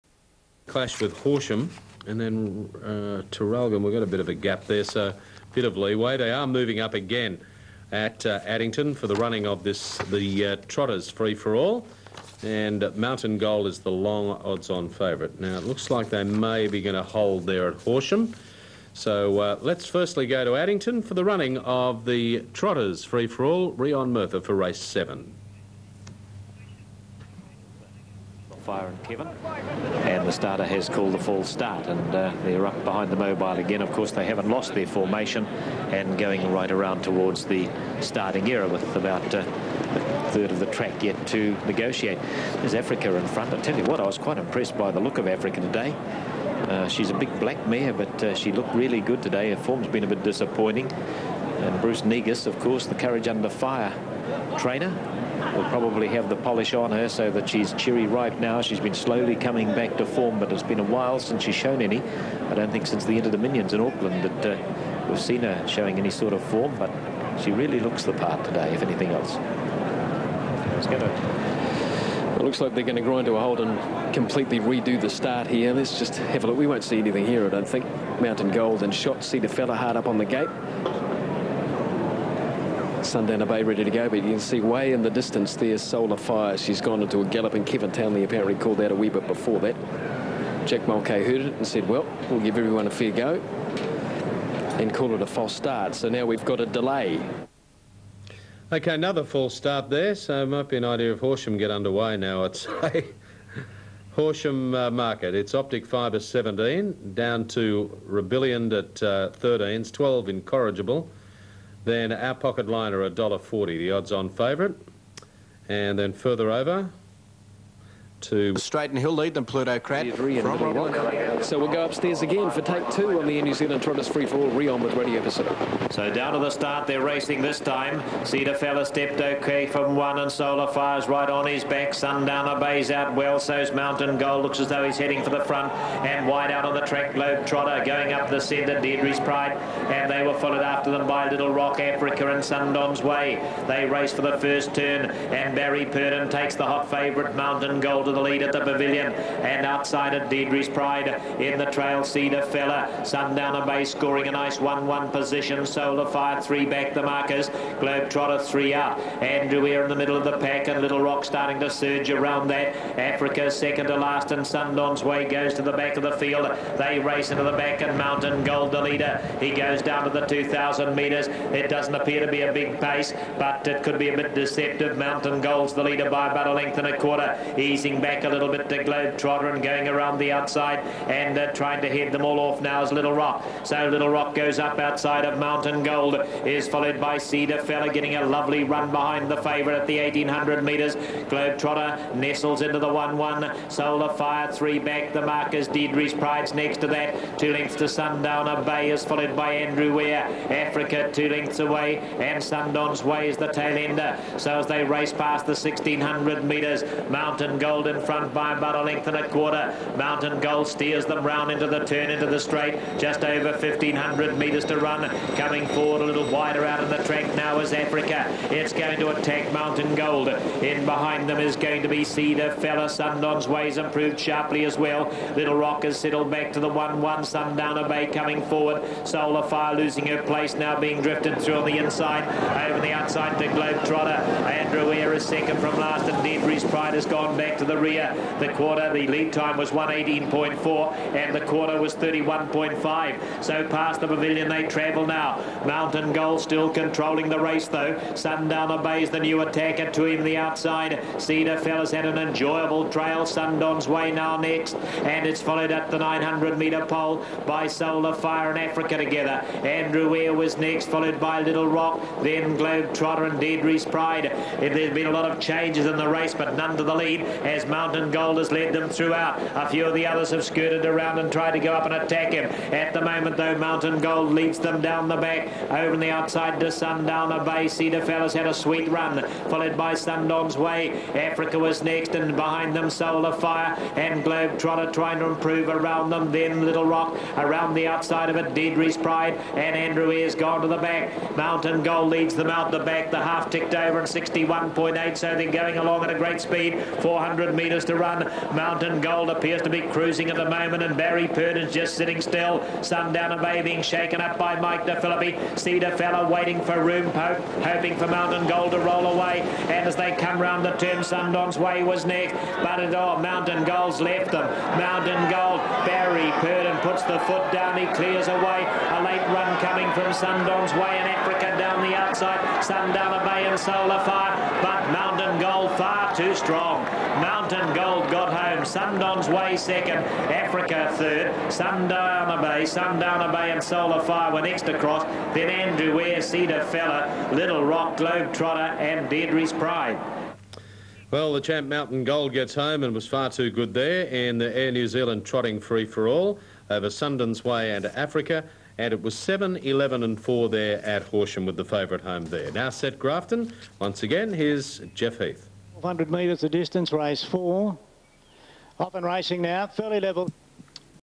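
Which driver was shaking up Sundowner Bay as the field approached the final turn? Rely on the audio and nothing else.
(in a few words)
Mike DeFilippi.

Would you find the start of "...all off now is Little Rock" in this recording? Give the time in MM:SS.
03:02.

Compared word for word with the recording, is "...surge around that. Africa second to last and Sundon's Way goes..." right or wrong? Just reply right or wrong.
right.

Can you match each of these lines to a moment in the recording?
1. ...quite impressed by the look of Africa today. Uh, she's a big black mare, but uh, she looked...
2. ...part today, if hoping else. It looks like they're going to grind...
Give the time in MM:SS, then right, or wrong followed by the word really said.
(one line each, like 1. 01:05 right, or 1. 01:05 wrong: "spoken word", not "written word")
1. 00:44 right
2. 01:08 wrong: "anything", not "hoping".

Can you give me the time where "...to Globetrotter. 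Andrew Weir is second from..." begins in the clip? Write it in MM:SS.
03:53.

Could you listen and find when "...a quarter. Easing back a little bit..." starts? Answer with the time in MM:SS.
02:56.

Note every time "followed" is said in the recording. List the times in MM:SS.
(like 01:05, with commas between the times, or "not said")
02:20, 03:06, 03:19, 04:15, 04:20, 04:39.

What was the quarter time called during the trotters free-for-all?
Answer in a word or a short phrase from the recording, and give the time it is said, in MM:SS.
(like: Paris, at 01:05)
31.5, at 04:01.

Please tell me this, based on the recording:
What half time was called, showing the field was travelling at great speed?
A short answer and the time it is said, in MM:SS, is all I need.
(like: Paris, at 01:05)
61.8, at 04:54.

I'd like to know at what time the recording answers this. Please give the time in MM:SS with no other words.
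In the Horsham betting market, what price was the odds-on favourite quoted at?
01:53.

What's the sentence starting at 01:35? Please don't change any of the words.
So now we've got a delay.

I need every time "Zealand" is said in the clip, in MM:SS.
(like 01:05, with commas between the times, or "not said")
02:03, 05:44.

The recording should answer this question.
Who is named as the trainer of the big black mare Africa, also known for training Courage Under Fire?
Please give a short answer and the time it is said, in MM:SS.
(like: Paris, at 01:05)
Bruce Negus, at 00:51.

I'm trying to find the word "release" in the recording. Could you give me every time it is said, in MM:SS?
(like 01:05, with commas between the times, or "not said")
not said.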